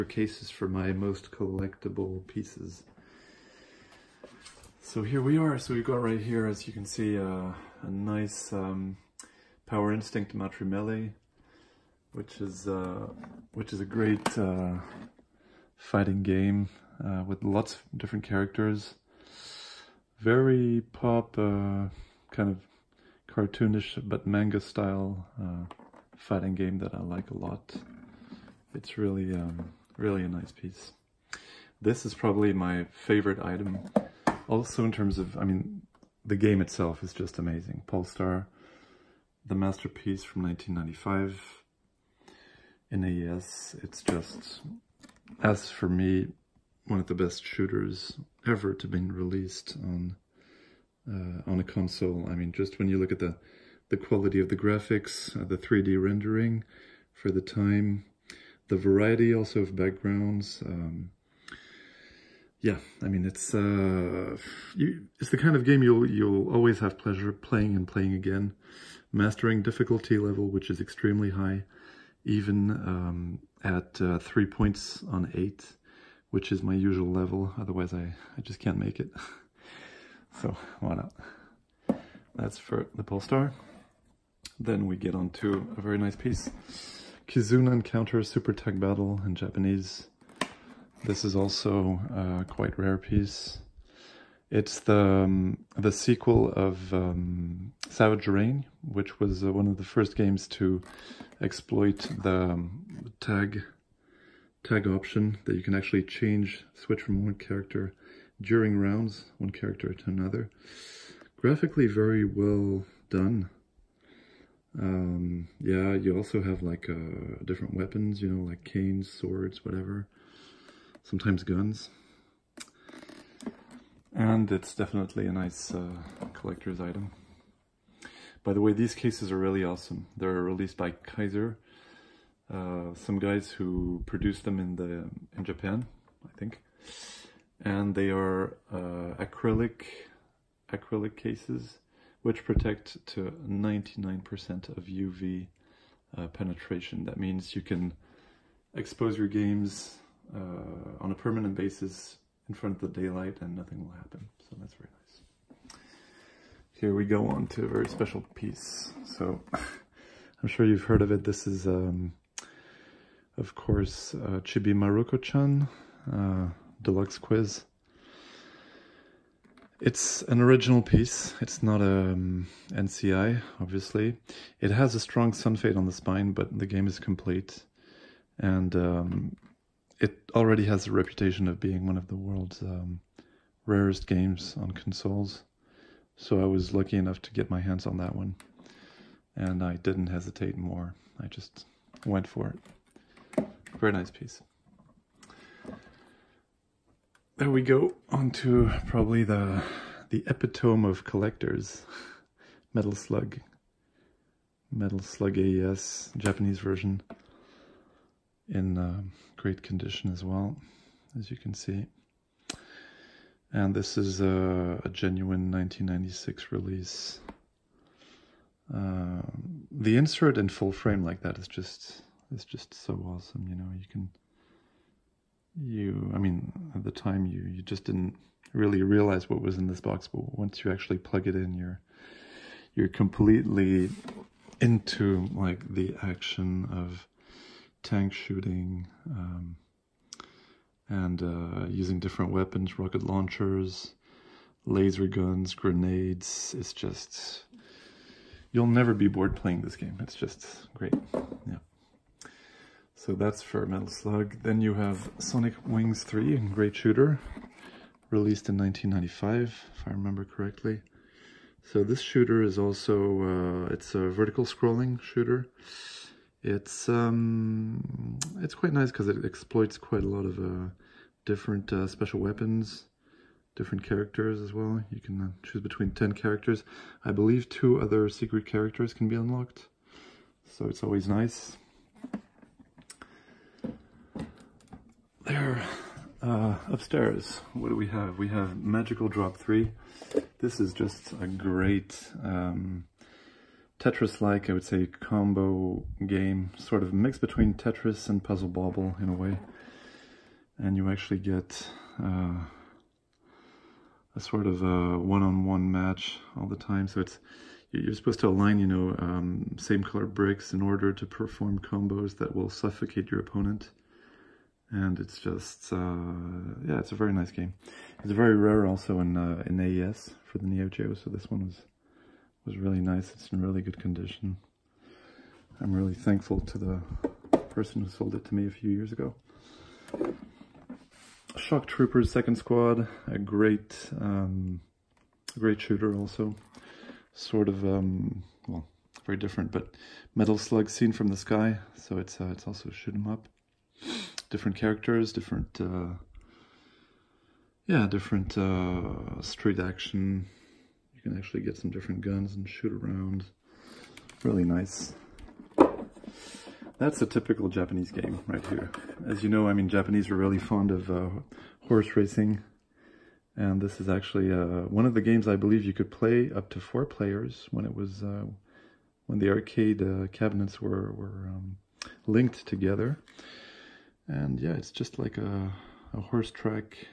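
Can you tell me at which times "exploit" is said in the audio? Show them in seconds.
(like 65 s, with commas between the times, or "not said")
101 s, 269 s.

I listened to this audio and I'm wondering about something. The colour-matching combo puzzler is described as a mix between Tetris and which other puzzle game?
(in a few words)
Puzzle Bobble.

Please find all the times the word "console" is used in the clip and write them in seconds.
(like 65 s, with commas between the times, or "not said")
51 s, 184 s.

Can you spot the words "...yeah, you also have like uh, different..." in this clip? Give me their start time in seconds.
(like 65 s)
115 s.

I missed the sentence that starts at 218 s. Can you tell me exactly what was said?
Uh, the insert in full frame like that is just it's just so awesome.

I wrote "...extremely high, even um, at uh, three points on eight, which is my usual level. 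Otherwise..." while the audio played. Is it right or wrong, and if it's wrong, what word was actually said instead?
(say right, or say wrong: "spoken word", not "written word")
right.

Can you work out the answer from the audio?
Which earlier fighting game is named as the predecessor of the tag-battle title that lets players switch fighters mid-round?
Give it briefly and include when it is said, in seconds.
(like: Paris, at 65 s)
Savage Reign, at 97 s.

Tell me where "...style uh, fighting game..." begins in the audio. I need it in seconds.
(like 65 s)
24 s.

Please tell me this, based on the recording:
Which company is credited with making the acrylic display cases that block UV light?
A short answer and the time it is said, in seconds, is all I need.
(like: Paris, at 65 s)
Kaiser, at 130 s.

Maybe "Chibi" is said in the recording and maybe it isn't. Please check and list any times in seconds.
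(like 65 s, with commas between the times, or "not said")
164 s.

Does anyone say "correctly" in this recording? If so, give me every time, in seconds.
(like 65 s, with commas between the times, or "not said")
260 s.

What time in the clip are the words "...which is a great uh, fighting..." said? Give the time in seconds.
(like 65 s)
13 s.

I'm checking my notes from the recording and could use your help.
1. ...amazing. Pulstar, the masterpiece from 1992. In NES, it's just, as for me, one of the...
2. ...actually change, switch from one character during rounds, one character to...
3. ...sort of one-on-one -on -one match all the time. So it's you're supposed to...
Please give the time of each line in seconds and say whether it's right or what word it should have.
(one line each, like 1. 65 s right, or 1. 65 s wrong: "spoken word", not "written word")
1. 37 s wrong: "1995", not "1992"
2. 105 s right
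3. 304 s right.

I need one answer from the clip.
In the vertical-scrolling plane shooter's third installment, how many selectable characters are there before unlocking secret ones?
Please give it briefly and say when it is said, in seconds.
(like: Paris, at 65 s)
10, at 275 s.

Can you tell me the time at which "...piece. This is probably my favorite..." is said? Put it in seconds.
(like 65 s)
30 s.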